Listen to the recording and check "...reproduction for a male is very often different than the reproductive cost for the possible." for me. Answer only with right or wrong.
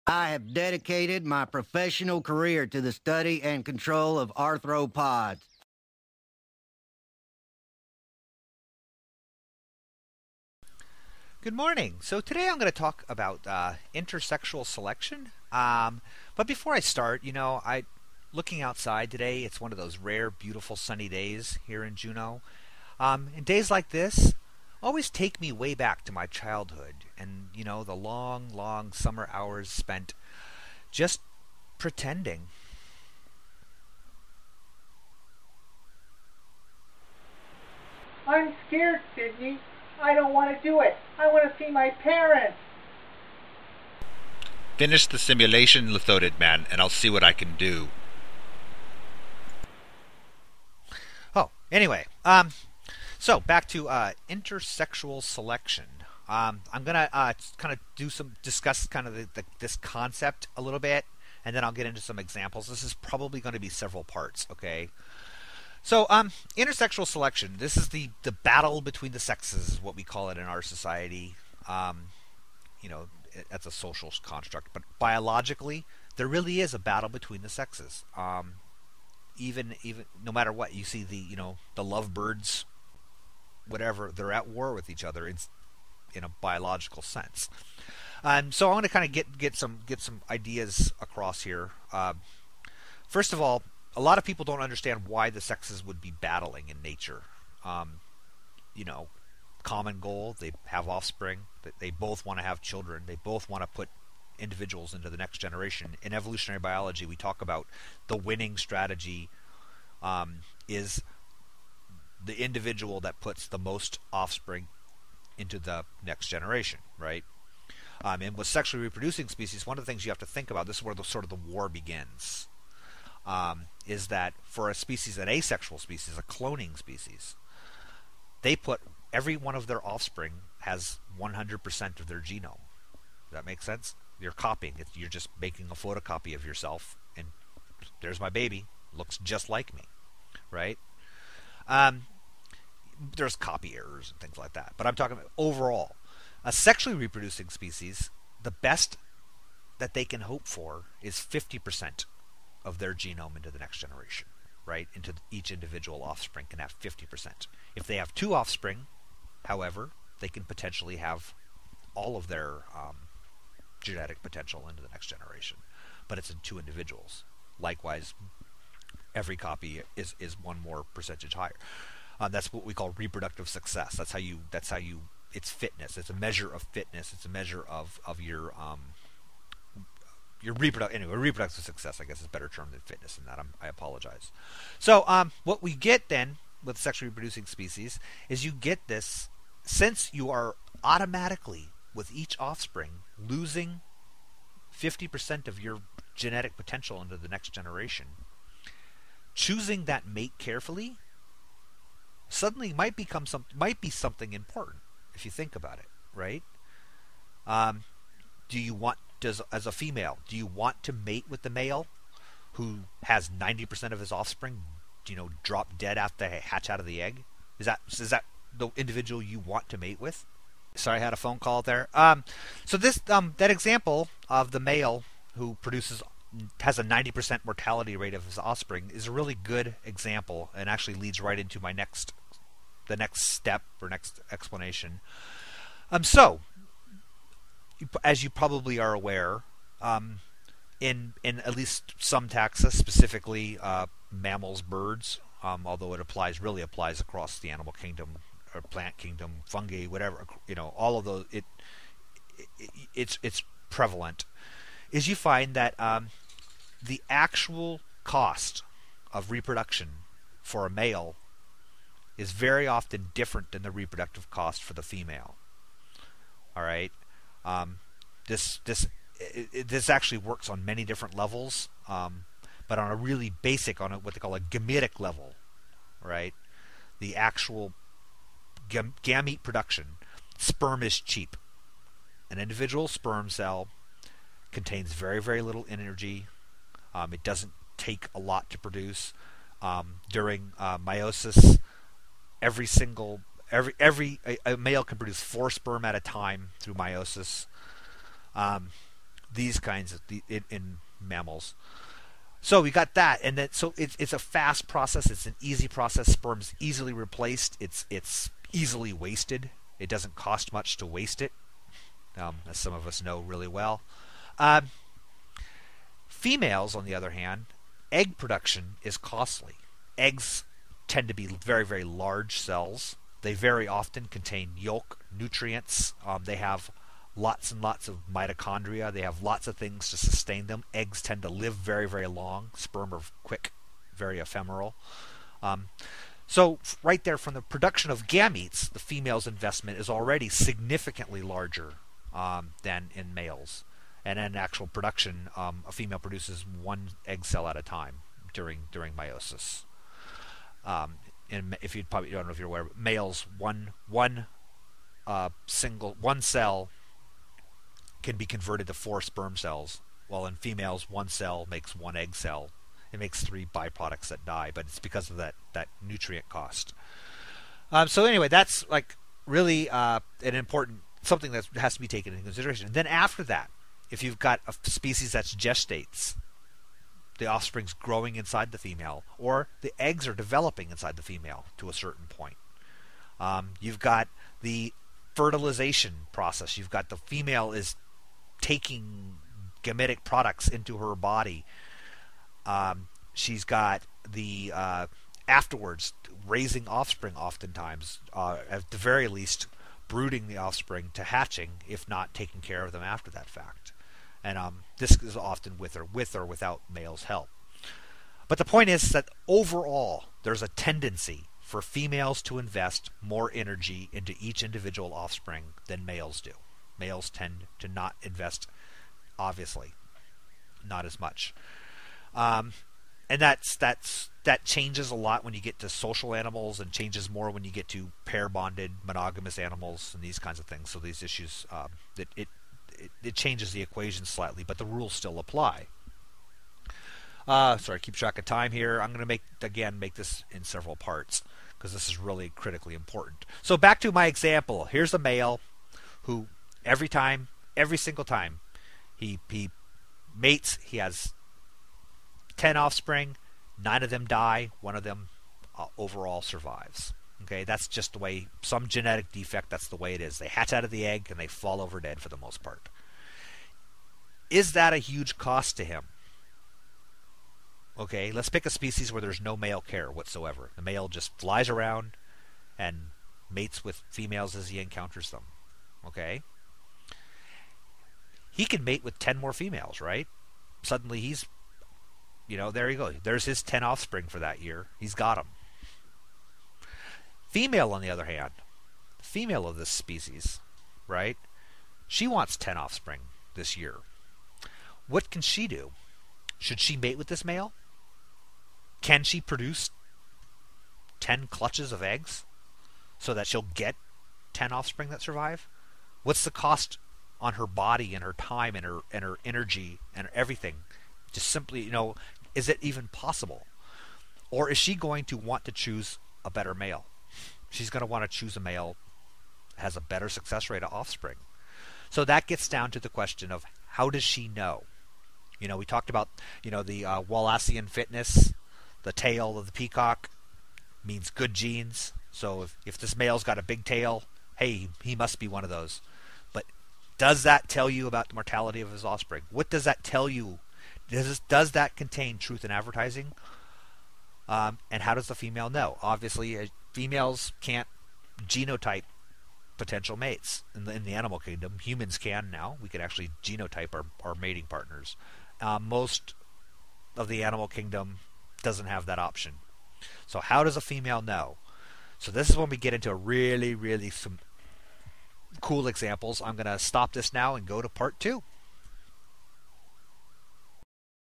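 wrong.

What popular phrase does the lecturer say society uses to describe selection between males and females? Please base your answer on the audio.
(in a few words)
the battle between the sexes.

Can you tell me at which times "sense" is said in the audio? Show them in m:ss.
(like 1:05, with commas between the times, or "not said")
1:27, 2:13.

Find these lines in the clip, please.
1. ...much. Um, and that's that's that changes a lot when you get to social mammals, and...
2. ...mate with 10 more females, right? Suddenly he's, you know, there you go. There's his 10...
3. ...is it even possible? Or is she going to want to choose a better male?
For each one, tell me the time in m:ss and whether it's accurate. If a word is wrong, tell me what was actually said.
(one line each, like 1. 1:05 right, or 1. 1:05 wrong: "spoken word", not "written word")
1. 7:00 wrong: "animals", not "mammals"
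2. 7:58 right
3. 8:32 right.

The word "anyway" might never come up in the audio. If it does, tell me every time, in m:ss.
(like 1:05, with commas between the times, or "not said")
0:51, 3:01, 6:08.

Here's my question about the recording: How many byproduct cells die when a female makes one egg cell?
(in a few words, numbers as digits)
3.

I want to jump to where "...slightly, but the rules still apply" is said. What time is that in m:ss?
7:14.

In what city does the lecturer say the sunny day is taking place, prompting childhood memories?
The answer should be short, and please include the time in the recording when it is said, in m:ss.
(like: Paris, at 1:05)
Juneau, at 0:21.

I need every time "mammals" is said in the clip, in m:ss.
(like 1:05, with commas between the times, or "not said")
4:04, 5:00.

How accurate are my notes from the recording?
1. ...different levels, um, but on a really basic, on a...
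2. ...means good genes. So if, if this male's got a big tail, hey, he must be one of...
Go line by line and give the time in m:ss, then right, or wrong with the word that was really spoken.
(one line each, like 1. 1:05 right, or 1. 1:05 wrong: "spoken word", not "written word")
1. 4:30 right
2. 8:50 right.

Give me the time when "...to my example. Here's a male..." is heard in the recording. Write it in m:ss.
7:23.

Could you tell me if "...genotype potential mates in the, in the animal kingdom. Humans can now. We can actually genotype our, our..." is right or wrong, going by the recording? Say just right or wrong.
right.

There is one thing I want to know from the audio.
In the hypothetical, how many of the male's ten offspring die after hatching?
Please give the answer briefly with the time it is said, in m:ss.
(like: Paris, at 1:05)
9, at 7:33.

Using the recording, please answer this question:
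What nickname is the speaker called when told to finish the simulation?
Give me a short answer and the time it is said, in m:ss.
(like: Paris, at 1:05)
Lithodid Man, at 0:45.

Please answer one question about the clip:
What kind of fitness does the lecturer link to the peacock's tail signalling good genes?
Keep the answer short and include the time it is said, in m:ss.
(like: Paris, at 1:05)
Wallacean fitness, at 8:47.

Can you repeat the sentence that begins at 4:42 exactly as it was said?
An individual sperm cell contains very very little energy.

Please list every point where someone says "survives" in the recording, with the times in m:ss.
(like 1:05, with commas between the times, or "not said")
7:36, 8:25.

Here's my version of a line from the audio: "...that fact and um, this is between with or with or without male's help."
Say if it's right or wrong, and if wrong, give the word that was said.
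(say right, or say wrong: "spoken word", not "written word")
wrong: "often", not "between".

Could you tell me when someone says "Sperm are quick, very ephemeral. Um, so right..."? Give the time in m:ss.
5:32.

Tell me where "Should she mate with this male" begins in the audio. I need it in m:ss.
8:16.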